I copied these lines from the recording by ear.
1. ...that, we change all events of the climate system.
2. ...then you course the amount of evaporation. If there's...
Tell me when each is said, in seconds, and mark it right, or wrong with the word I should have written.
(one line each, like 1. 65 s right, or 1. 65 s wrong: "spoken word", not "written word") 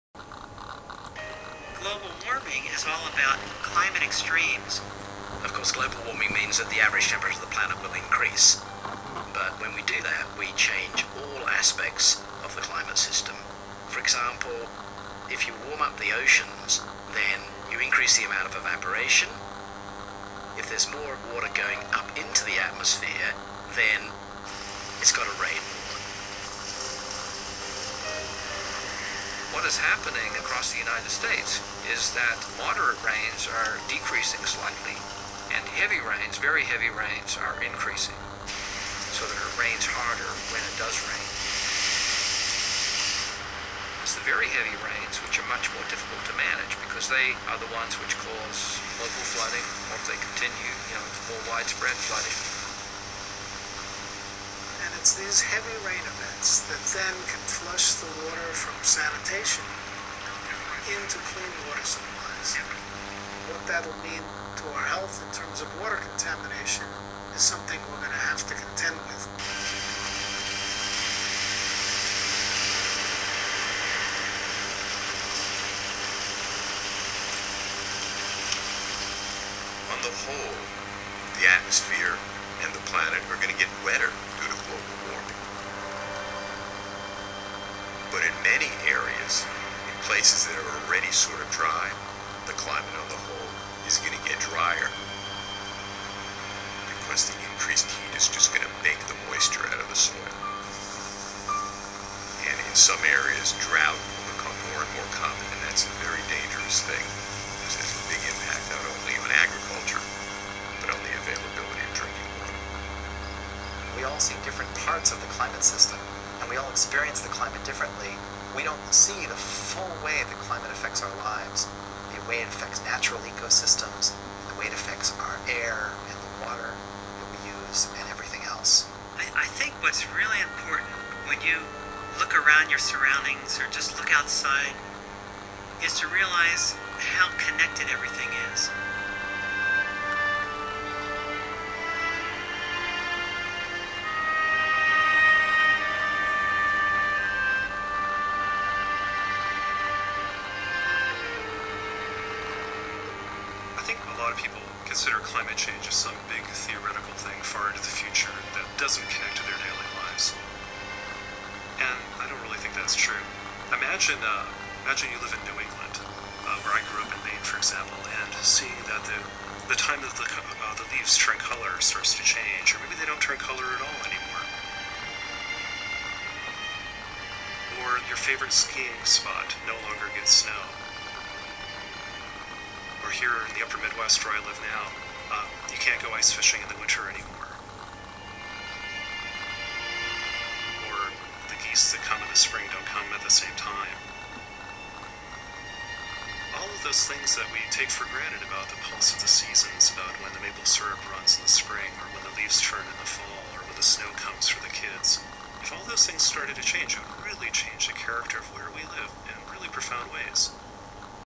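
1. 10 s wrong: "aspects", not "events"
2. 17 s wrong: "increase", not "course".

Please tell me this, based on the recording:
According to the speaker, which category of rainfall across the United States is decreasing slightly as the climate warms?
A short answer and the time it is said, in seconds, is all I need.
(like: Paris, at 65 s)
moderate rains, at 32 s.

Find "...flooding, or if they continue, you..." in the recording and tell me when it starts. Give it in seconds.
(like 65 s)
49 s.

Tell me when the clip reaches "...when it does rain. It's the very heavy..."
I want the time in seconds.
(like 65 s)
40 s.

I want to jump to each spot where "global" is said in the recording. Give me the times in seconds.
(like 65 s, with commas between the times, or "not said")
5 s, 84 s.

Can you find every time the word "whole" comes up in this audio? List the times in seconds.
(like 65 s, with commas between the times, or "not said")
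80 s, 93 s.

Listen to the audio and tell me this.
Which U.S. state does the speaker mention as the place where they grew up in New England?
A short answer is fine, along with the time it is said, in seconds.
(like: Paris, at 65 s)
Maine, at 167 s.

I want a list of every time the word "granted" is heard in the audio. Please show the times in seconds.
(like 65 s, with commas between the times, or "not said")
198 s.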